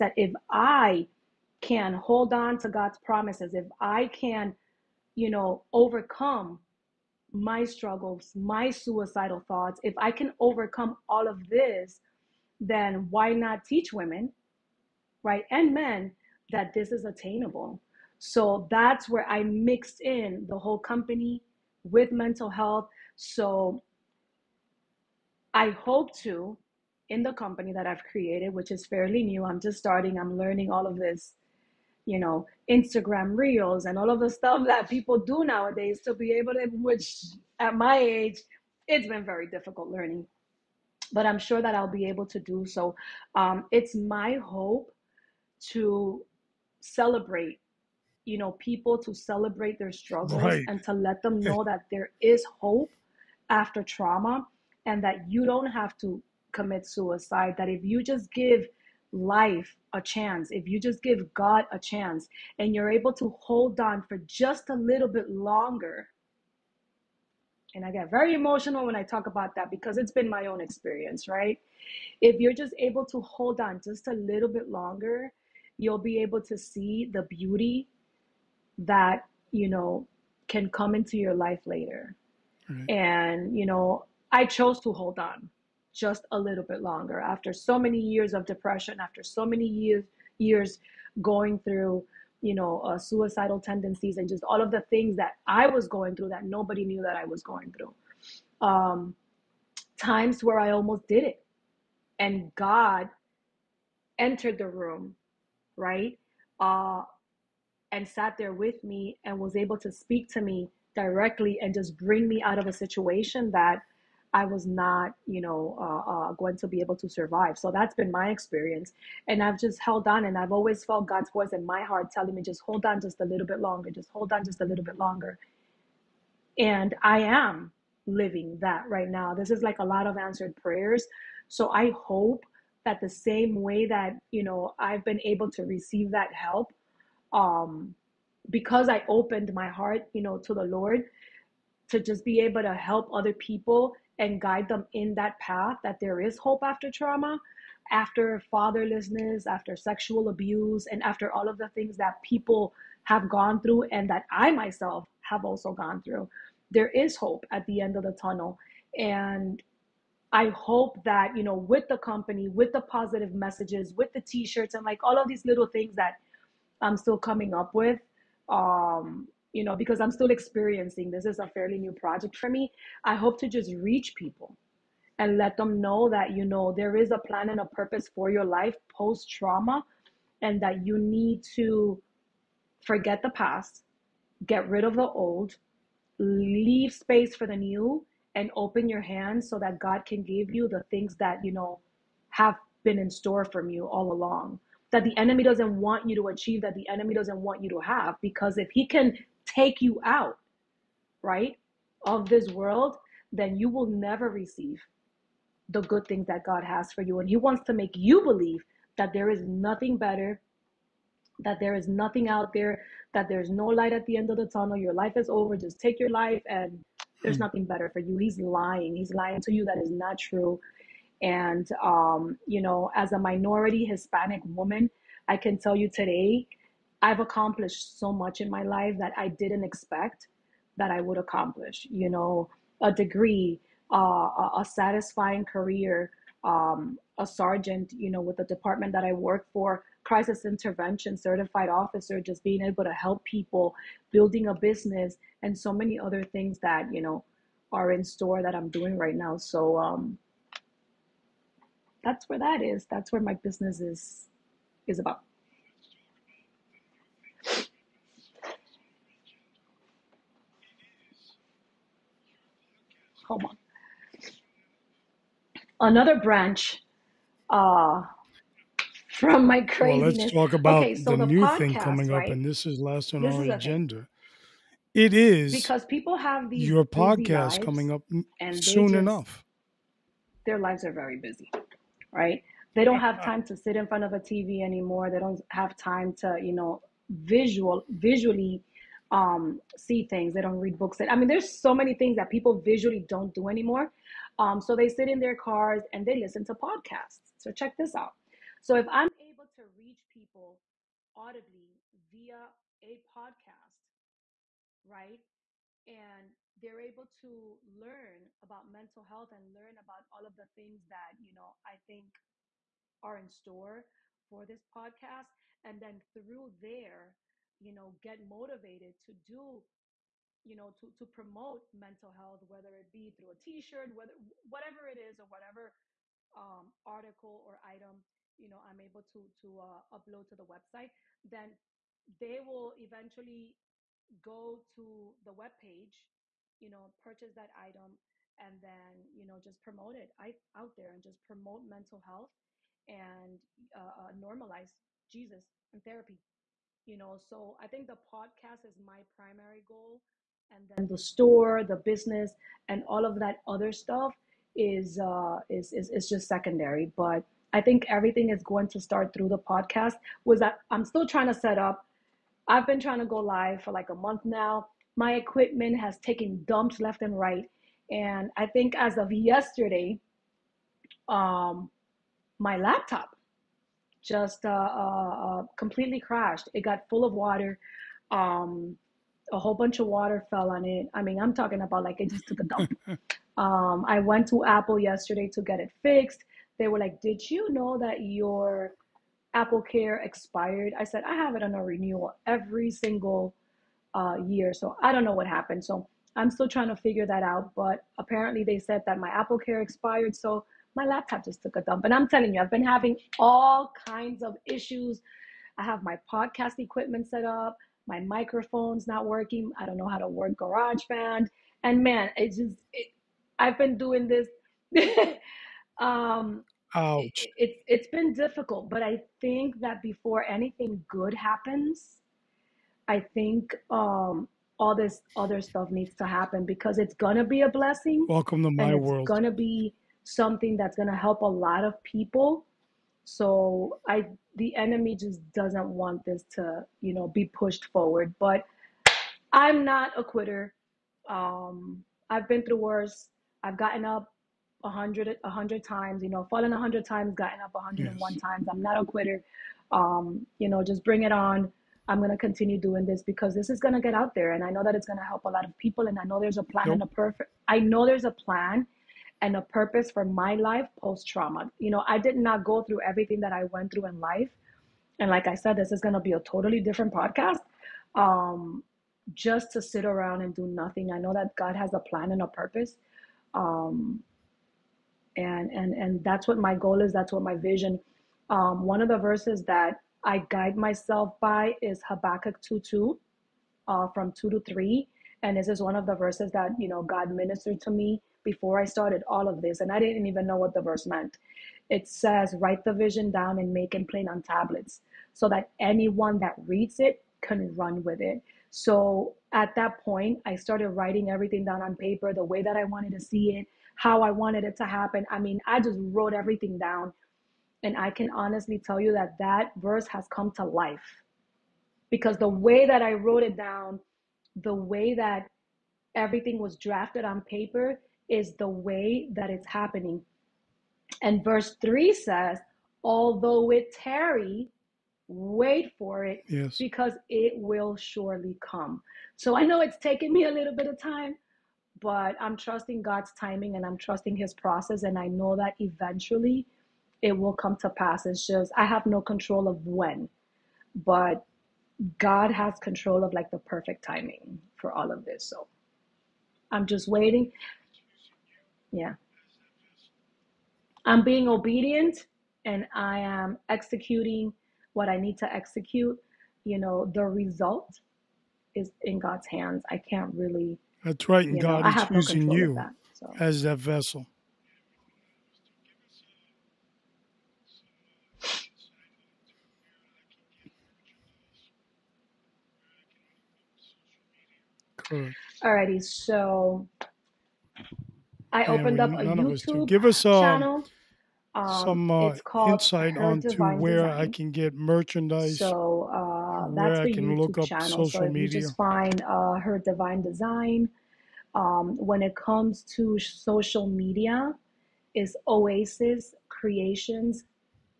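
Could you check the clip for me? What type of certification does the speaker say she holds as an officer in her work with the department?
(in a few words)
Crisis intervention.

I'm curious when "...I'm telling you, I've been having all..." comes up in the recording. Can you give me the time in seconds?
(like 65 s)
401 s.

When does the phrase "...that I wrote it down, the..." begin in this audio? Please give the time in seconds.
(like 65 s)
512 s.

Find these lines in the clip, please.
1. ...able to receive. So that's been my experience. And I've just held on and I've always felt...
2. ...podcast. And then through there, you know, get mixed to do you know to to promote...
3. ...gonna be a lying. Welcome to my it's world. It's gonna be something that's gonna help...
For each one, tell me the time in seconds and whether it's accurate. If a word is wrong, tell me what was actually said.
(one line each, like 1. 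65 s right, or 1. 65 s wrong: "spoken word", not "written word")
1. 116 s wrong: "survive", not "receive"
2. 314 s wrong: "motivated", not "mixed"
3. 426 s wrong: "blessing", not "lying".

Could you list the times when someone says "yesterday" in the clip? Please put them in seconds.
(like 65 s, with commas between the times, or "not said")
369 s, 384 s.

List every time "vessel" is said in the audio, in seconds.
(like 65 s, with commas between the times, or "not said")
563 s.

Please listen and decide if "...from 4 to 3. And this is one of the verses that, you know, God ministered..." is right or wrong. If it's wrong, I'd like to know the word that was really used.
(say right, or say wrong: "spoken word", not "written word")
wrong: "2", not "4".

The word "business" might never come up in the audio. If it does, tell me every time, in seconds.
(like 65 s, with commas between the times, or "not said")
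244 s, 253 s, 351 s.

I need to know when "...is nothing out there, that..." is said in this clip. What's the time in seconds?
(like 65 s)
211 s.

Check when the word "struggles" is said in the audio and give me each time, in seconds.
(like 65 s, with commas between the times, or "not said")
7 s, 49 s.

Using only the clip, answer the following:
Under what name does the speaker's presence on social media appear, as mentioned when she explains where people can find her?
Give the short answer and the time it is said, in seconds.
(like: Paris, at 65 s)
Oasis Creations, at 595 s.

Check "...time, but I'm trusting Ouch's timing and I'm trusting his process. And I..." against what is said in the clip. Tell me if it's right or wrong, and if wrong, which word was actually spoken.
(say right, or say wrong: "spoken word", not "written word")
wrong: "God", not "Ouch".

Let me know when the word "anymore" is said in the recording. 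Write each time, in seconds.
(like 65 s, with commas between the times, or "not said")
284 s, 293 s.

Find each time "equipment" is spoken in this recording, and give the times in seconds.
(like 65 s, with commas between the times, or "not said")
365 s, 406 s.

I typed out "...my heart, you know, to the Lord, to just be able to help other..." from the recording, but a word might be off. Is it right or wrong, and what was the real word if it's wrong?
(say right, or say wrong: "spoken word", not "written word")
right.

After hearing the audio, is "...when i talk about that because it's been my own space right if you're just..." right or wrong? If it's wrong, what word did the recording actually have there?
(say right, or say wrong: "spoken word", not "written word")
wrong: "experience", not "space".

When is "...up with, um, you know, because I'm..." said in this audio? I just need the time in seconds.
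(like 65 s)
167 s.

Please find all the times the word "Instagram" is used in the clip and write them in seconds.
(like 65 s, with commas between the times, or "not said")
32 s.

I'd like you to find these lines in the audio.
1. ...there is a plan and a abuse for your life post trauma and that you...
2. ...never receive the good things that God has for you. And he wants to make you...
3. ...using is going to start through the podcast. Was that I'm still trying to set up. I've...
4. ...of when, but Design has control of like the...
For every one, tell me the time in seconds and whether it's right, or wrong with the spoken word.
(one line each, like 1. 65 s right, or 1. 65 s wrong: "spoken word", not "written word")
1. 176 s wrong: "purpose", not "abuse"
2. 203 s right
3. 357 s wrong: "everything", not "using"
4. 539 s wrong: "God", not "Design".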